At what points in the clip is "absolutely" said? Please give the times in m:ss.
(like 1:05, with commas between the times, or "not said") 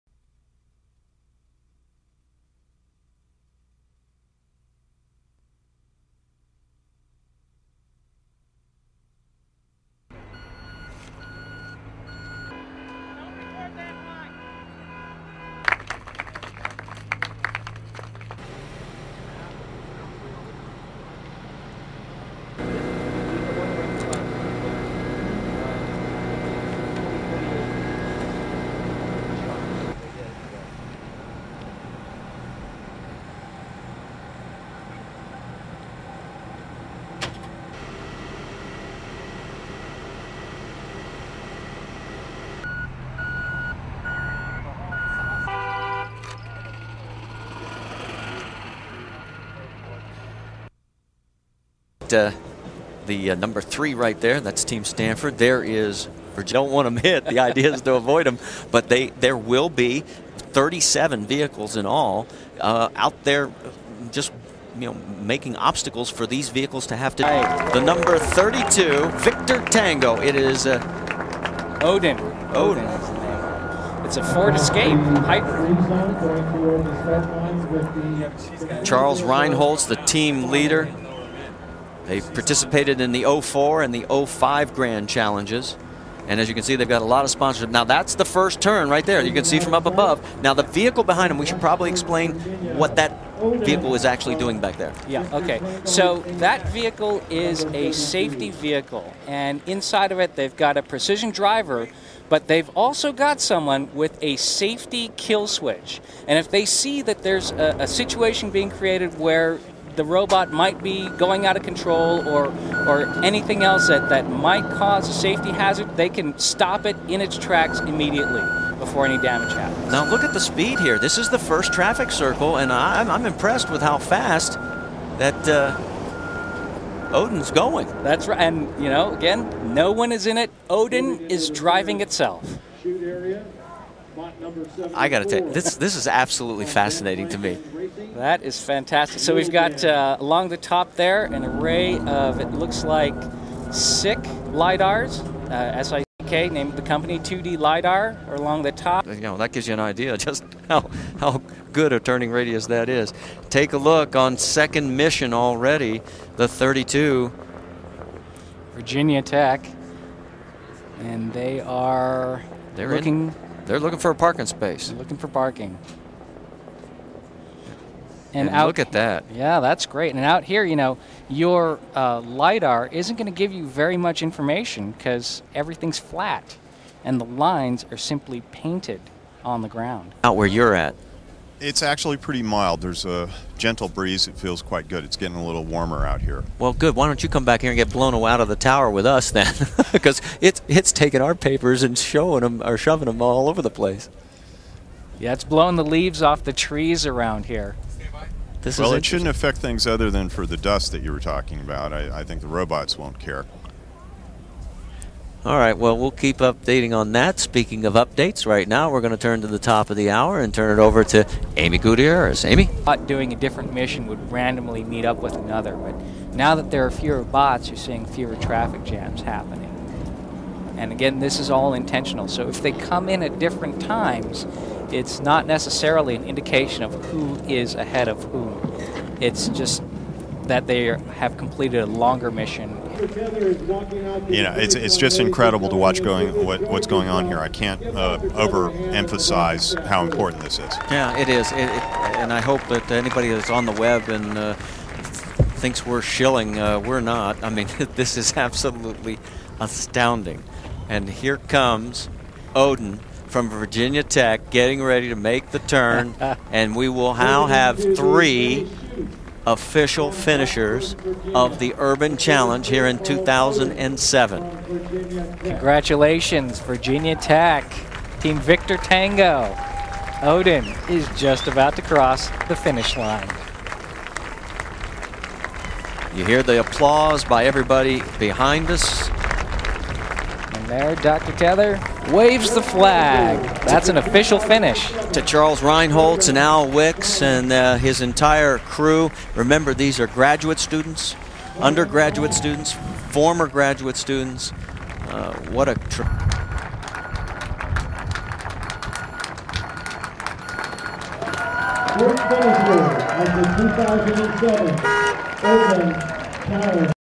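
2:16, 4:08.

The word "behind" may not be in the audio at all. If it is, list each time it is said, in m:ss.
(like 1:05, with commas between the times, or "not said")
1:31, 4:38.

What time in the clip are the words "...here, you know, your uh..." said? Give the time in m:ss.
2:50.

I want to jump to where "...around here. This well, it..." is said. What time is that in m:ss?
3:17.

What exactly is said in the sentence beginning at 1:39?
And inside of it, they've got a precision driver, but they've also got someone with a safety kill switch.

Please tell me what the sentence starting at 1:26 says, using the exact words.
And as you can see, they've got a lot of sponsorship.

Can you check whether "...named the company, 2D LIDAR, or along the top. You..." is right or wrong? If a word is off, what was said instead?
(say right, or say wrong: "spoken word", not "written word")
right.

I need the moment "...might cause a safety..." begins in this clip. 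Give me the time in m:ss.
1:54.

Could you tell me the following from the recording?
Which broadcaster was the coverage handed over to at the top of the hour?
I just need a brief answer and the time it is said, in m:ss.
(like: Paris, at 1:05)
Amy Gutierrez, at 3:31.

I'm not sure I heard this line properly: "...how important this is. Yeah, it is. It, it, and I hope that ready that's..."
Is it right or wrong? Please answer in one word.
wrong.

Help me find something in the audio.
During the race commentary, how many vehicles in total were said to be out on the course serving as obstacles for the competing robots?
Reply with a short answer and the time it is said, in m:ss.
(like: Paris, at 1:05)
37, at 1:00.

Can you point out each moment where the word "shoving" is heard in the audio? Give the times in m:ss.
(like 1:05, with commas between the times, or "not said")
3:12.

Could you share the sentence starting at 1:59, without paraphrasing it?
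Now look at the speed here.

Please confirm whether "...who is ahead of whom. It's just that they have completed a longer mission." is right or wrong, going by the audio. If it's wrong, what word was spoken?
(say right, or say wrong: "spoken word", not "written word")
right.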